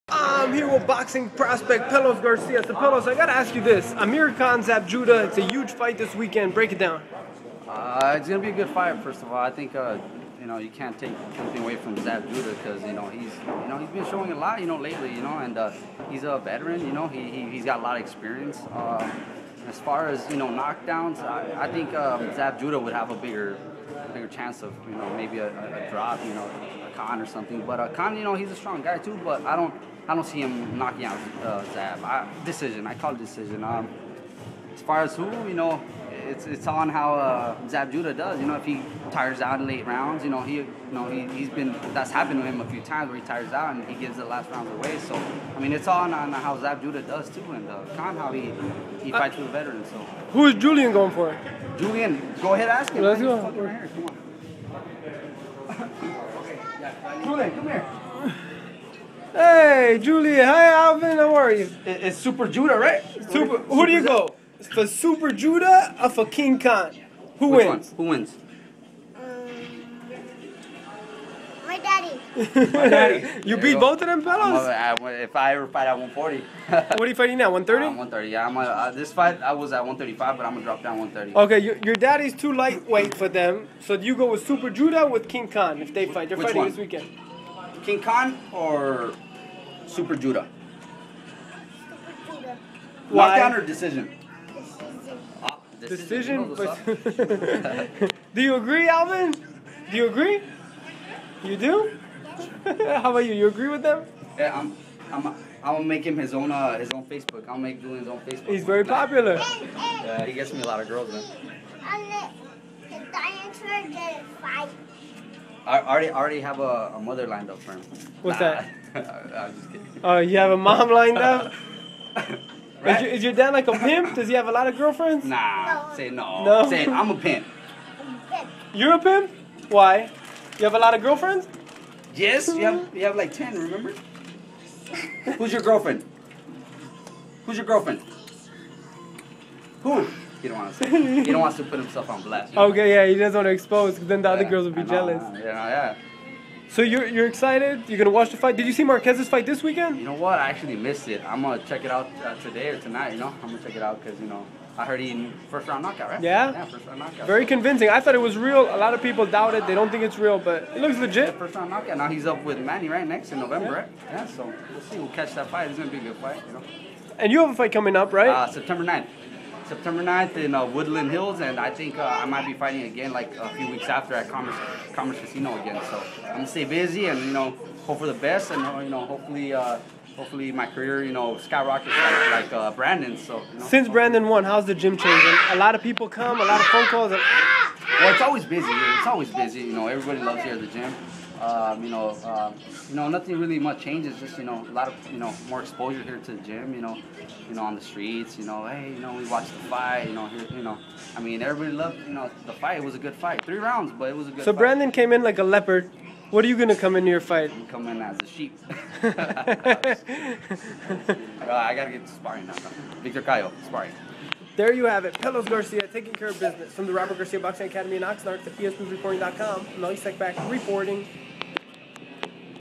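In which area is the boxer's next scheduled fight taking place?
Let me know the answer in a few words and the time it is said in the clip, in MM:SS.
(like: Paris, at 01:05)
Woodland Hills, at 02:50.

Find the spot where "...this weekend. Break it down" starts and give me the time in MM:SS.
00:05.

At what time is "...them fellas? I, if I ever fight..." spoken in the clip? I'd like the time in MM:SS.
01:14.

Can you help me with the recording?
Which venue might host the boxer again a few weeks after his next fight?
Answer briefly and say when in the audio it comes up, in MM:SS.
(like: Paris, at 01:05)
Commerce Casino, at 02:54.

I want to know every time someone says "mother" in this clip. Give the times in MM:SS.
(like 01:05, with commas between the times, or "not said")
01:56.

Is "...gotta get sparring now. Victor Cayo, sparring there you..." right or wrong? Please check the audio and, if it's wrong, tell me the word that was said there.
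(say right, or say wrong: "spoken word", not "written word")
right.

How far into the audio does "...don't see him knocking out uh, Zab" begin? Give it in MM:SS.
00:30.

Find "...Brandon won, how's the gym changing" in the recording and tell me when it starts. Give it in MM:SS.
03:03.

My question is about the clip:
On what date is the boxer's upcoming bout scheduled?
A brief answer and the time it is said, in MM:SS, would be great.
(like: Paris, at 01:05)
September 9th, at 02:48.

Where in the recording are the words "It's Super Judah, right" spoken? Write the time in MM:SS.
01:01.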